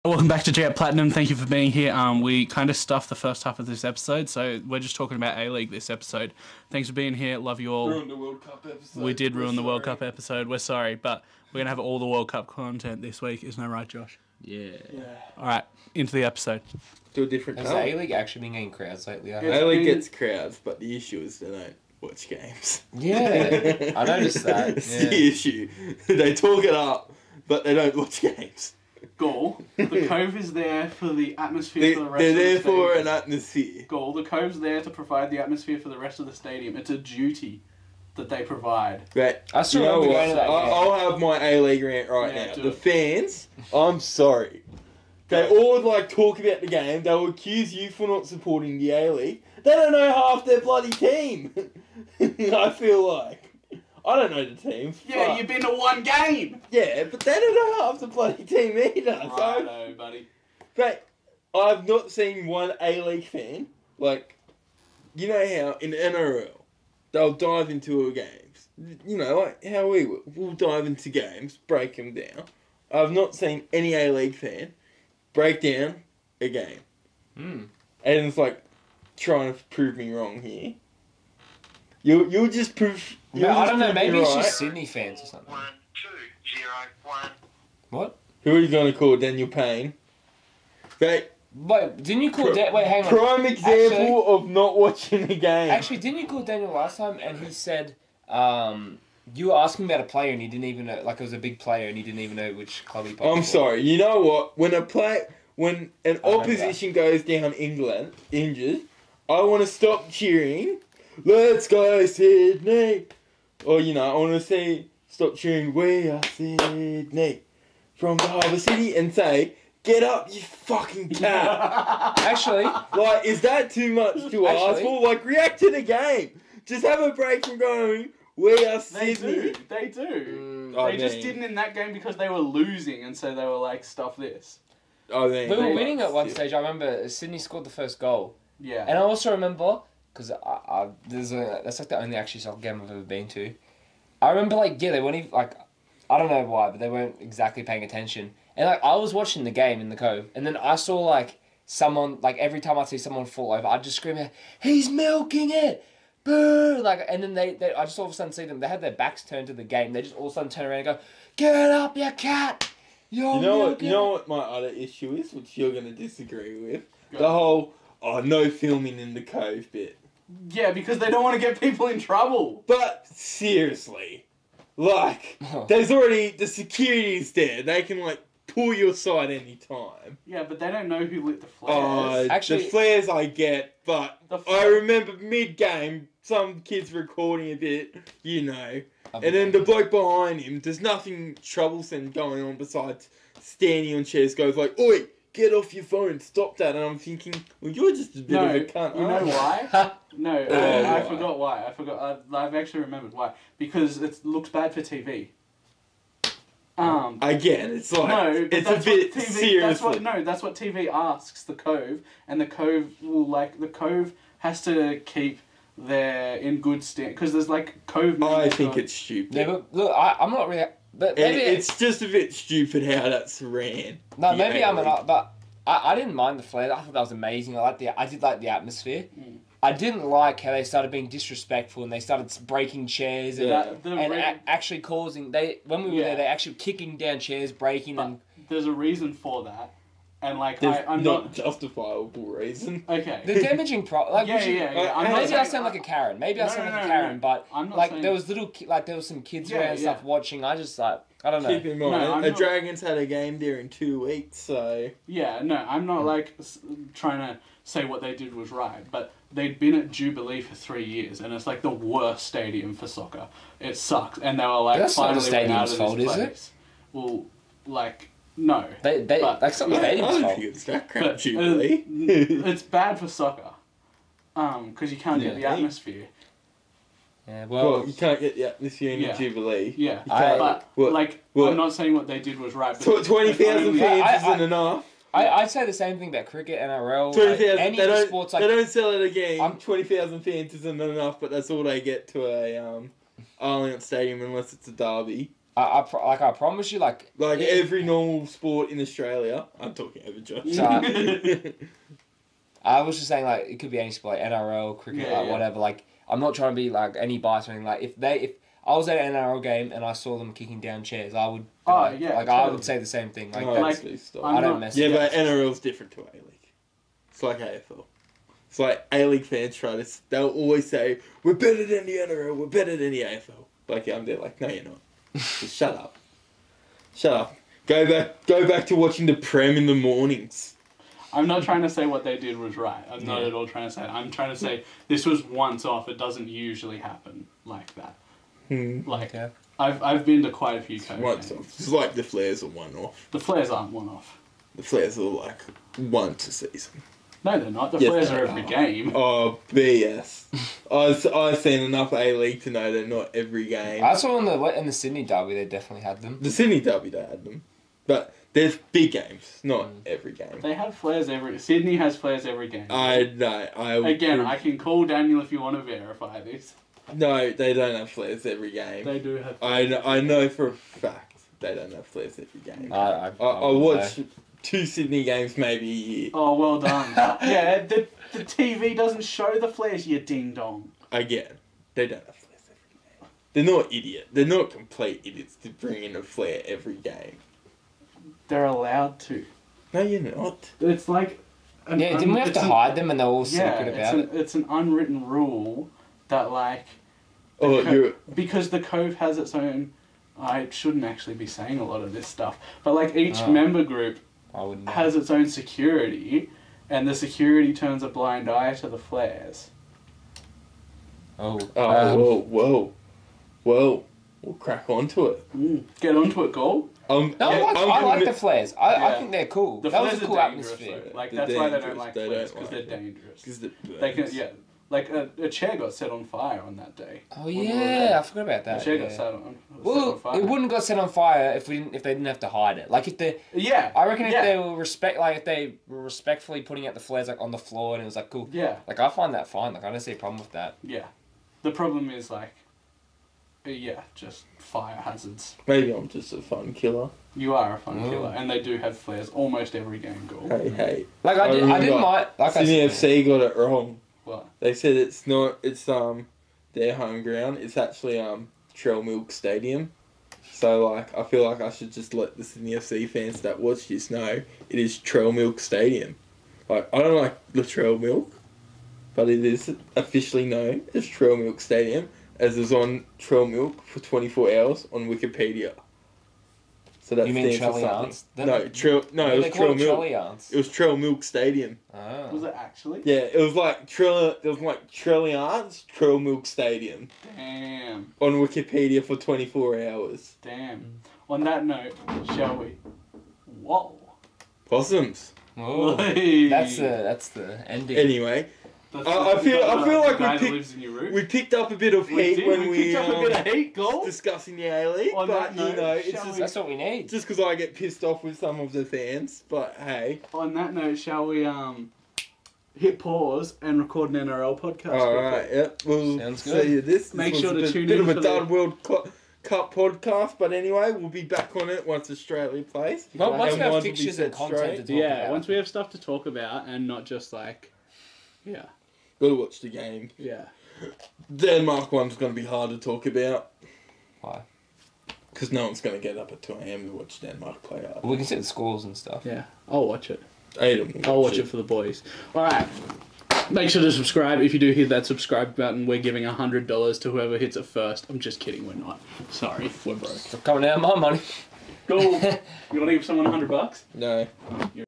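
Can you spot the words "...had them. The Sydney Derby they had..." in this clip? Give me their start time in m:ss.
5:55.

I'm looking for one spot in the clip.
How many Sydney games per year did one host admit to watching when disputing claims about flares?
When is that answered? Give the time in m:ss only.
6:14.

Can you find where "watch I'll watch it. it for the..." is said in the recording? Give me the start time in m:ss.
9:00.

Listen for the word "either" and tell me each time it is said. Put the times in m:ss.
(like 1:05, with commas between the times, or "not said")
0:58.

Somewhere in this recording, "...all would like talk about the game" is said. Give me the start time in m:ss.
0:45.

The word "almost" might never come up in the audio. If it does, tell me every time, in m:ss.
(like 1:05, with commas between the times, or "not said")
7:29.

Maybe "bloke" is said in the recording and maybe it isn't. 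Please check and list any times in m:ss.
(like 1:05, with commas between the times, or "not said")
3:09.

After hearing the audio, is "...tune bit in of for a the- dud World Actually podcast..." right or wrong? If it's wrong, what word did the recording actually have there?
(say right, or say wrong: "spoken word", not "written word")
wrong: "Cup", not "Actually".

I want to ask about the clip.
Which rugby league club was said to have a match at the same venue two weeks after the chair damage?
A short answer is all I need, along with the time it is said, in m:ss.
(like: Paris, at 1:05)
Dragons, at 4:12.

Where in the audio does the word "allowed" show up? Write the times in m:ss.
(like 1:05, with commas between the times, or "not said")
6:28.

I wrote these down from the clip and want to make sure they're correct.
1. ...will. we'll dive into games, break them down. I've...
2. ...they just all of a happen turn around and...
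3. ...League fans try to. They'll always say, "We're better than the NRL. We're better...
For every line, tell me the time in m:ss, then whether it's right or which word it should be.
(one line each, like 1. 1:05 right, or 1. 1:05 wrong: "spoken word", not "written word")
1. 1:10 right
2. 2:39 wrong: "sudden", not "happen"
3. 5:19 right.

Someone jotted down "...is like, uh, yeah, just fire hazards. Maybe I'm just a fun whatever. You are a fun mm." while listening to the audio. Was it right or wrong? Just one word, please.
wrong.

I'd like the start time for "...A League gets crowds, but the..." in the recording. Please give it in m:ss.
0:19.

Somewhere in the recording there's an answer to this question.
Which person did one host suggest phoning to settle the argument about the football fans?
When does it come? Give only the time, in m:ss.
1:29.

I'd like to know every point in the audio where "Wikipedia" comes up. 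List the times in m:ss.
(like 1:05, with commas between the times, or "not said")
7:54, 8:08.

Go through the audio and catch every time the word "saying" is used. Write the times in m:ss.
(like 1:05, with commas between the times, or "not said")
4:07, 4:41, 5:03, 6:41.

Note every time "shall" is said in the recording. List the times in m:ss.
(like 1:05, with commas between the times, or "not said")
8:12, 8:30.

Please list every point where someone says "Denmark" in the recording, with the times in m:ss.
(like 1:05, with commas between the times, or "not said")
8:51, 8:57.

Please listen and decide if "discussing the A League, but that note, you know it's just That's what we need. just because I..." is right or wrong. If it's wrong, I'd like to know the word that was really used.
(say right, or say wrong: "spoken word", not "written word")
right.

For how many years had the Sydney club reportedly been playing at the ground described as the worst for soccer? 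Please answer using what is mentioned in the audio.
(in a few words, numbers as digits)
3.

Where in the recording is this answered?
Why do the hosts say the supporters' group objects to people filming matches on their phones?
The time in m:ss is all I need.
3:24.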